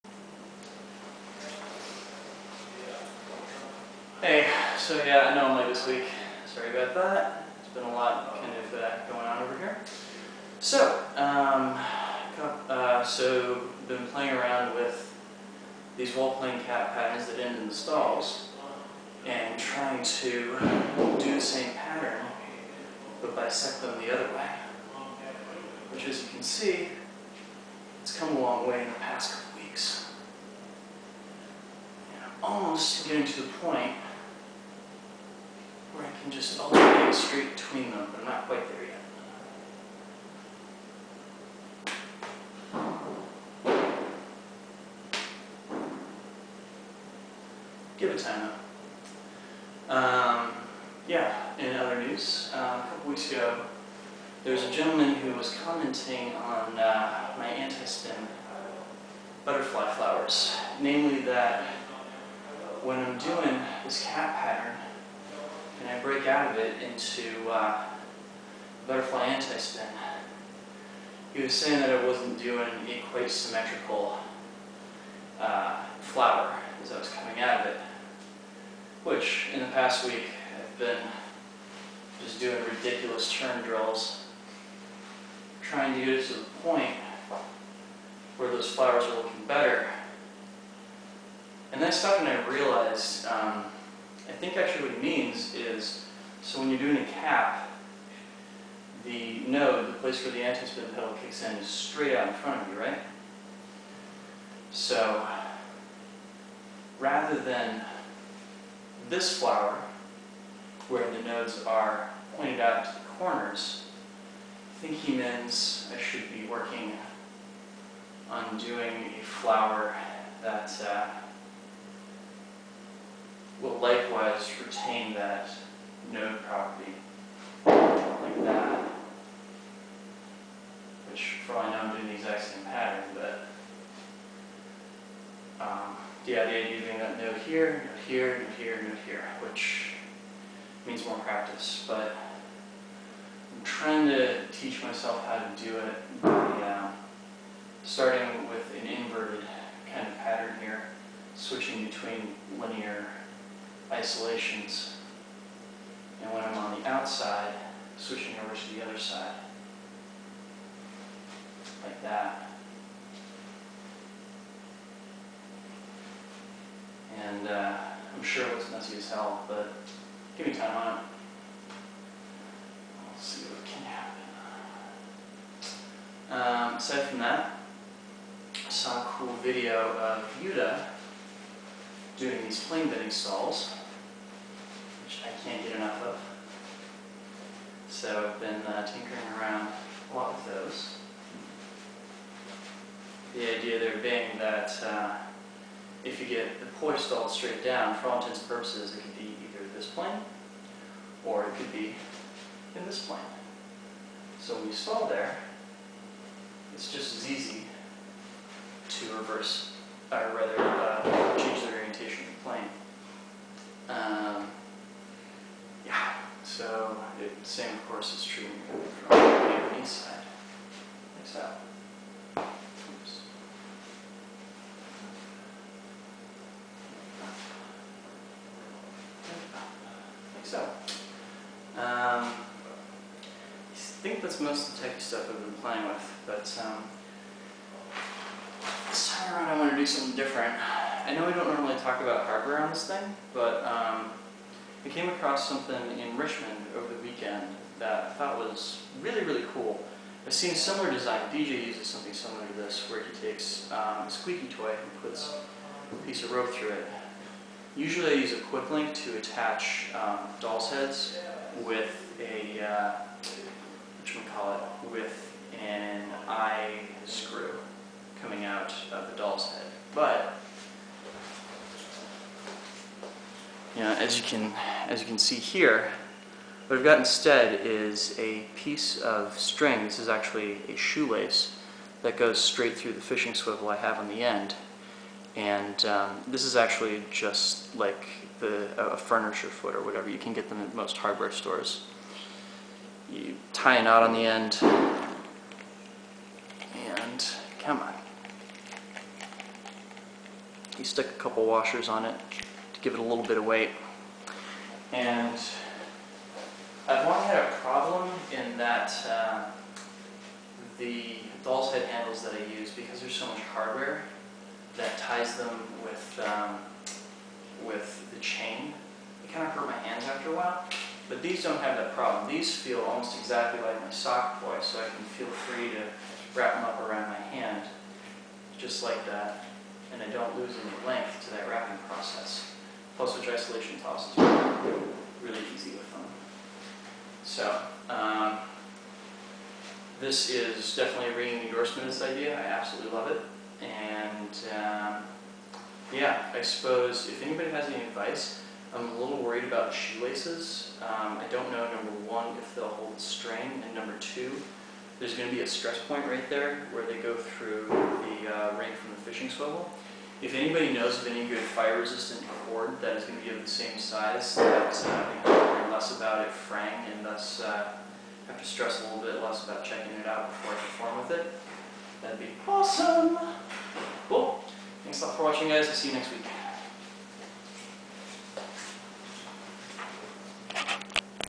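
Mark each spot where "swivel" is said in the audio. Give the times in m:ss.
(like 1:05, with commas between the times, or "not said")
4:43, 5:59.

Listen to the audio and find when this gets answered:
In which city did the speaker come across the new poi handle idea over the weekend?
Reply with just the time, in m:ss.
4:06.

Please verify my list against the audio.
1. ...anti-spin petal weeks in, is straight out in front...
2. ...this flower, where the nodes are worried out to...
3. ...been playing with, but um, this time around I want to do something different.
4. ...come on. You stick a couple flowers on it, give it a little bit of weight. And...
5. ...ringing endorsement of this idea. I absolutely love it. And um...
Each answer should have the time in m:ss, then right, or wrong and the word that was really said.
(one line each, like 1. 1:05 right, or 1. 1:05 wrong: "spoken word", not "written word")
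1. 1:40 wrong: "kicks", not "weeks"
2. 1:49 wrong: "pointed", not "worried"
3. 3:55 right
4. 4:57 wrong: "washers", not "flowers"
5. 5:41 right.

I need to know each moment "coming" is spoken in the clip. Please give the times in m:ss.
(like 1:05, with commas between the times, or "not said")
1:17, 4:28.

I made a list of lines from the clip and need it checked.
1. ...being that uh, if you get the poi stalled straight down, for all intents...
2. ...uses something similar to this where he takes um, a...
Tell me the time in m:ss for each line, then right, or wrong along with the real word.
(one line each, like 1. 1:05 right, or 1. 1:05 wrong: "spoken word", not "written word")
1. 3:13 right
2. 4:11 right.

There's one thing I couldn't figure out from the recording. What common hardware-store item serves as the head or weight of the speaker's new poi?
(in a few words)
A furniture foot.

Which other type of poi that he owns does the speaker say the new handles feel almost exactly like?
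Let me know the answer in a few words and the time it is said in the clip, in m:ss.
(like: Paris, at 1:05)
Sock poi, at 5:23.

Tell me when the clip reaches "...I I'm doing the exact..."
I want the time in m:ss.
2:11.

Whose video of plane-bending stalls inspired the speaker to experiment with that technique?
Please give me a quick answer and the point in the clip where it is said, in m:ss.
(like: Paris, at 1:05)
Yuta, at 3:00.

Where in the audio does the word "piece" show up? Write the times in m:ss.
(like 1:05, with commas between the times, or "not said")
4:16, 4:38.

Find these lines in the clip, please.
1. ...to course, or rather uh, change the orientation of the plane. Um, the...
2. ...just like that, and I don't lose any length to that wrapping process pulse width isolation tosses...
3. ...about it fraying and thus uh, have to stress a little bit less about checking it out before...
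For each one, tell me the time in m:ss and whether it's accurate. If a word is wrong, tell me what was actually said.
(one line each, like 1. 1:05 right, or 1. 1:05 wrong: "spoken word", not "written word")
1. 3:28 wrong: "reverse", not "course"
2. 5:28 right
3. 6:05 right.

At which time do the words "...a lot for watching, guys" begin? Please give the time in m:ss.
6:15.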